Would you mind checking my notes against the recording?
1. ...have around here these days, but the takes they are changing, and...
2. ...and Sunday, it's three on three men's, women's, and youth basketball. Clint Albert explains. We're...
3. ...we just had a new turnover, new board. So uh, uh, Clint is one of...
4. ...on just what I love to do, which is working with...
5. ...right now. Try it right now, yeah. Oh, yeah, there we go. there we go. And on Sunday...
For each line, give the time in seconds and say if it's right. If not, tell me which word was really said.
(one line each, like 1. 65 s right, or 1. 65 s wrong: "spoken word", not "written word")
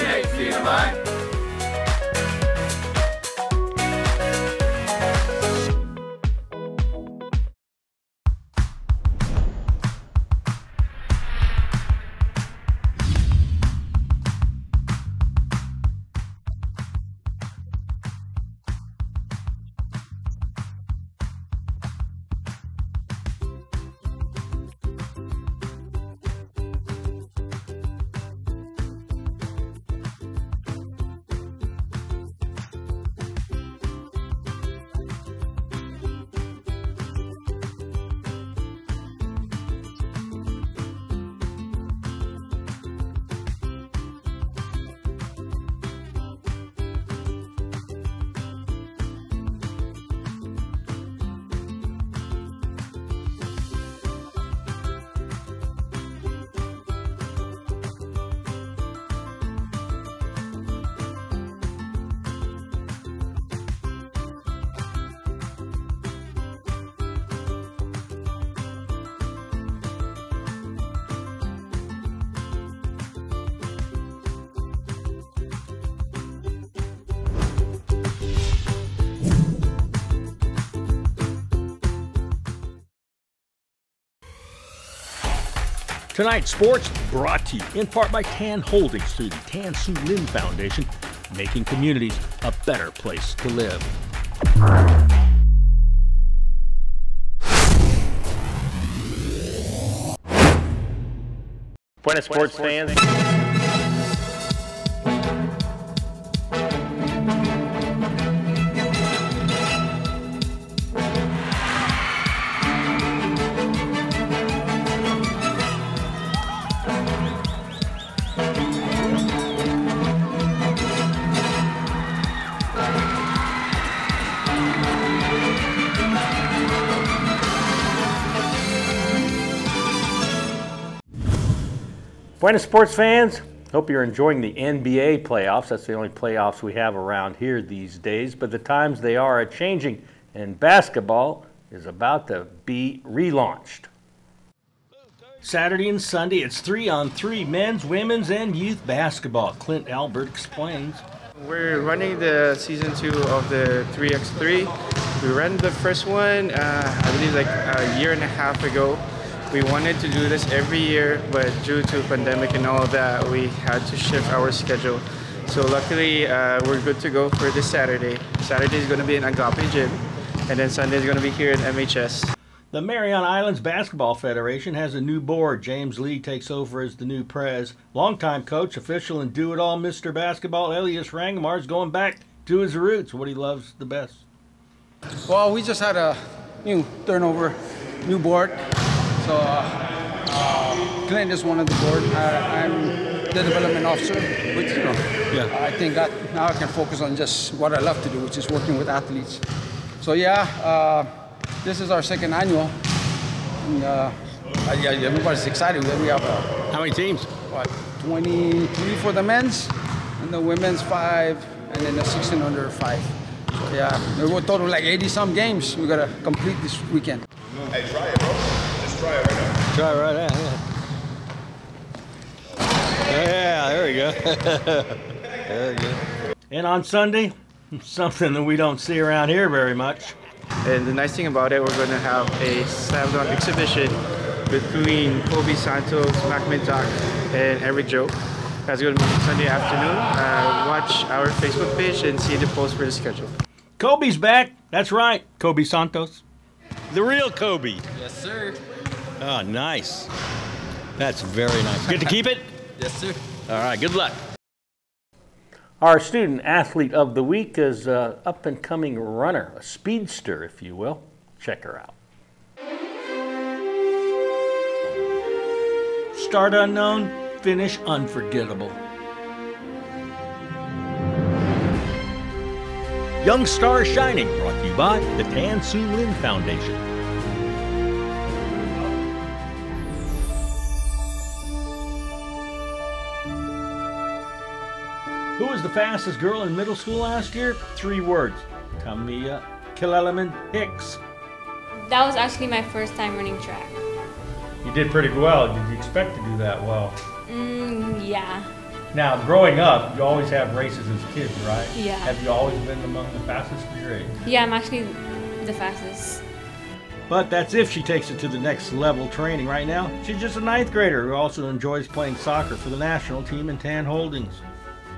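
1. 136 s wrong: "times", not "takes"
2. 145 s right
3. 185 s right
4. 196 s right
5. 219 s right.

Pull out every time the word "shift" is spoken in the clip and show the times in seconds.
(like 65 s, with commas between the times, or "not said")
163 s.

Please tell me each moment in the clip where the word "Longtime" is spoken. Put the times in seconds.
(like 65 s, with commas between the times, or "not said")
177 s.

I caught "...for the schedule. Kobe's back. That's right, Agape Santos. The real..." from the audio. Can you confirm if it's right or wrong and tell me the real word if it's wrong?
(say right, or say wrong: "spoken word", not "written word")
wrong: "Kobe", not "Agape".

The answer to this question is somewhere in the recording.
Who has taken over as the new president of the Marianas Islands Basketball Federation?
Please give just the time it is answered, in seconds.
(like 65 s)
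175 s.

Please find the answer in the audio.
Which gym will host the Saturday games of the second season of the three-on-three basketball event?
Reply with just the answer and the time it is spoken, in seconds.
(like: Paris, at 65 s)
Agape Gym, at 169 s.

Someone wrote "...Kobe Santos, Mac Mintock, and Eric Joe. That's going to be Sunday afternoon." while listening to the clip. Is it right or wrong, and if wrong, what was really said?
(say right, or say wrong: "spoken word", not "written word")
right.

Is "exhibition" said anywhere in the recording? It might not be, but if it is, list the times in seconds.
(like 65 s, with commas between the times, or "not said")
233 s.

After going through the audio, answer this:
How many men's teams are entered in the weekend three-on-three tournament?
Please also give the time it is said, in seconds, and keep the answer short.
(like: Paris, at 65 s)
23, at 208 s.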